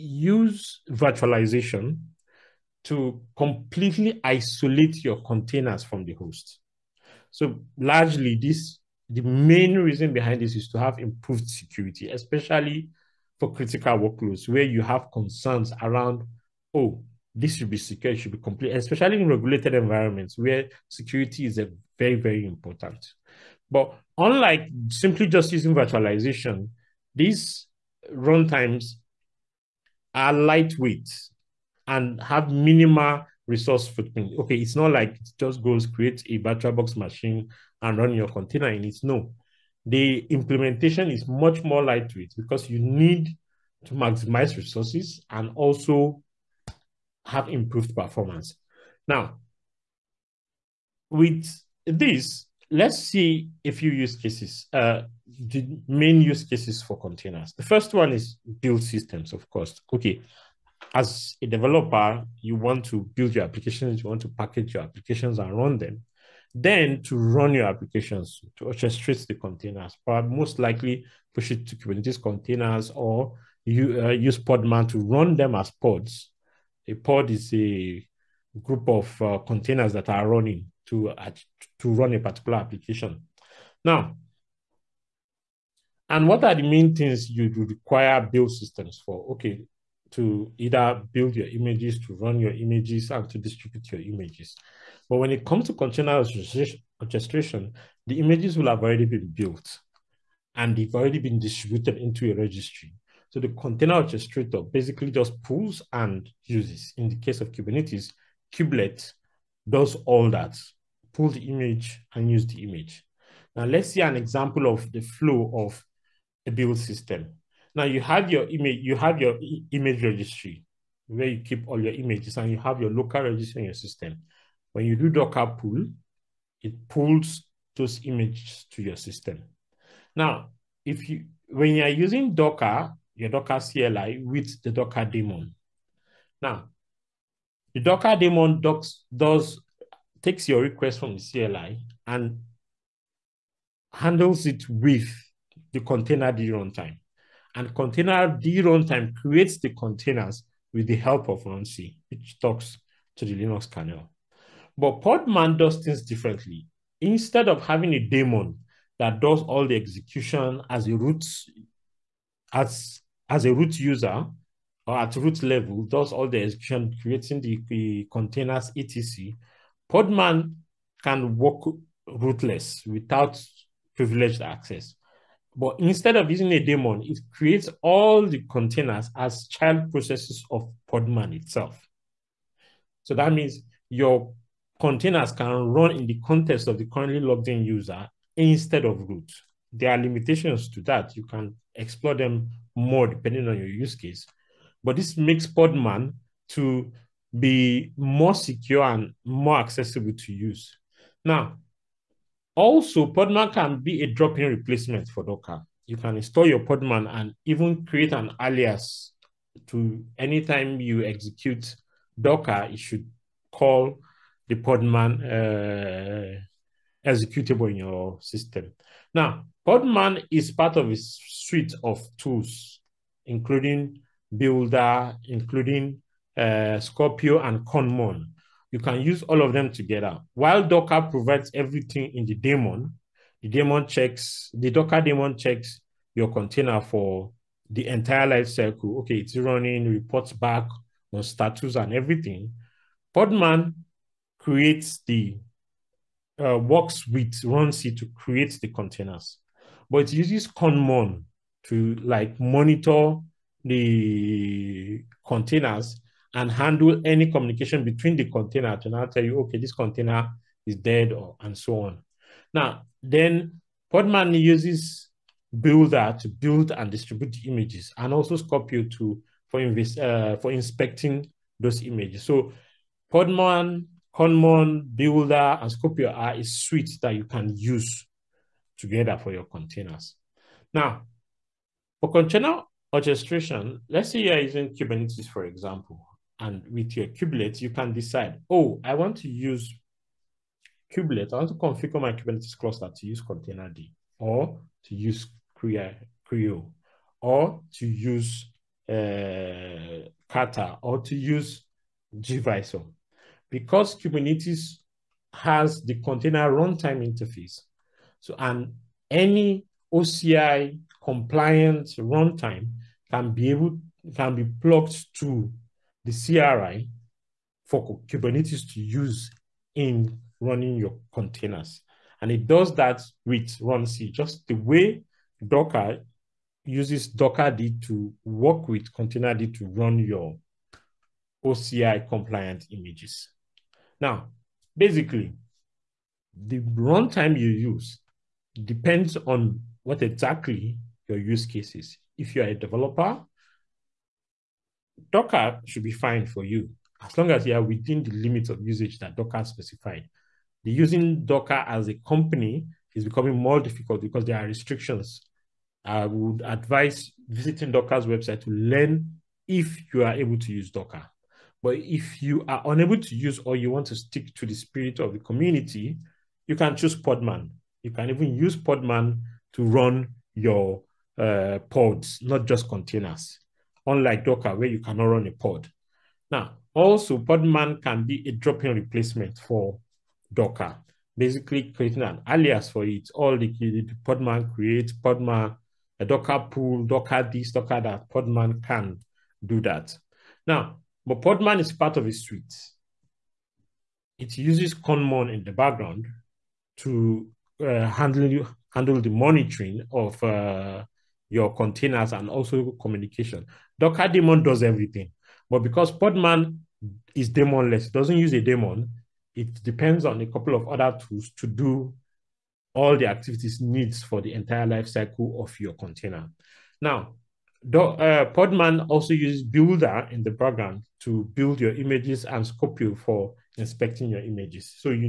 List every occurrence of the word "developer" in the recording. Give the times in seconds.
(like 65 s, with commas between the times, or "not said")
61 s, 342 s.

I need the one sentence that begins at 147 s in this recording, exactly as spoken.
And container D runtime creates the containers with the help of runc, which talks to the Linux kernel.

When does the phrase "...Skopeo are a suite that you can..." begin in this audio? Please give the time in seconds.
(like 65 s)
275 s.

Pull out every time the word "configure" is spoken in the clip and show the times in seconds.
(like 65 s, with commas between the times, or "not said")
291 s.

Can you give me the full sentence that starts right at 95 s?
But when it comes to container orchestration, the images will have already been built and they've already been distributed into a registry.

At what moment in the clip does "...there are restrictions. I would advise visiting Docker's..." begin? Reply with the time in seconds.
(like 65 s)
354 s.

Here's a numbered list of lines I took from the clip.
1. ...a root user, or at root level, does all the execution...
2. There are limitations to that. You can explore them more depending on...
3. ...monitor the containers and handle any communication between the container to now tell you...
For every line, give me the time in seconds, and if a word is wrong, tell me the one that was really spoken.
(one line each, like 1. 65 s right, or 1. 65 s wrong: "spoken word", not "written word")
1. 163 s right
2. 189 s right
3. 252 s right.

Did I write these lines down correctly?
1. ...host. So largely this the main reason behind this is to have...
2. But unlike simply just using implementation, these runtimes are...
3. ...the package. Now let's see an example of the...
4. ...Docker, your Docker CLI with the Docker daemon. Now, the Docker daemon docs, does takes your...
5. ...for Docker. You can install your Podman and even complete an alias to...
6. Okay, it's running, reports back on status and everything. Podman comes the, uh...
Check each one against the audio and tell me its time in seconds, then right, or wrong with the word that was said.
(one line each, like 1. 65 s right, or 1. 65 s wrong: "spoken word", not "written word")
1. 6 s right
2. 23 s wrong: "virtualization", not "implementation"
3. 112 s wrong: "image", not "package"
4. 132 s right
5. 205 s wrong: "create", not "complete"
6. 238 s wrong: "creates", not "comes".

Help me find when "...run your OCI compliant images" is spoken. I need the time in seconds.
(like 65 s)
329 s.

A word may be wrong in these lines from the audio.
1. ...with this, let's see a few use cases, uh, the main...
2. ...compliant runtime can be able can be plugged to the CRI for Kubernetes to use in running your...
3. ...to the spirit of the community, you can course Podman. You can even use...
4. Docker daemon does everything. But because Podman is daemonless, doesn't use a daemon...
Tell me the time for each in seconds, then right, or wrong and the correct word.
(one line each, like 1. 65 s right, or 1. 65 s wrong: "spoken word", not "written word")
1. 51 s right
2. 311 s right
3. 364 s wrong: "choose", not "course"
4. 403 s right.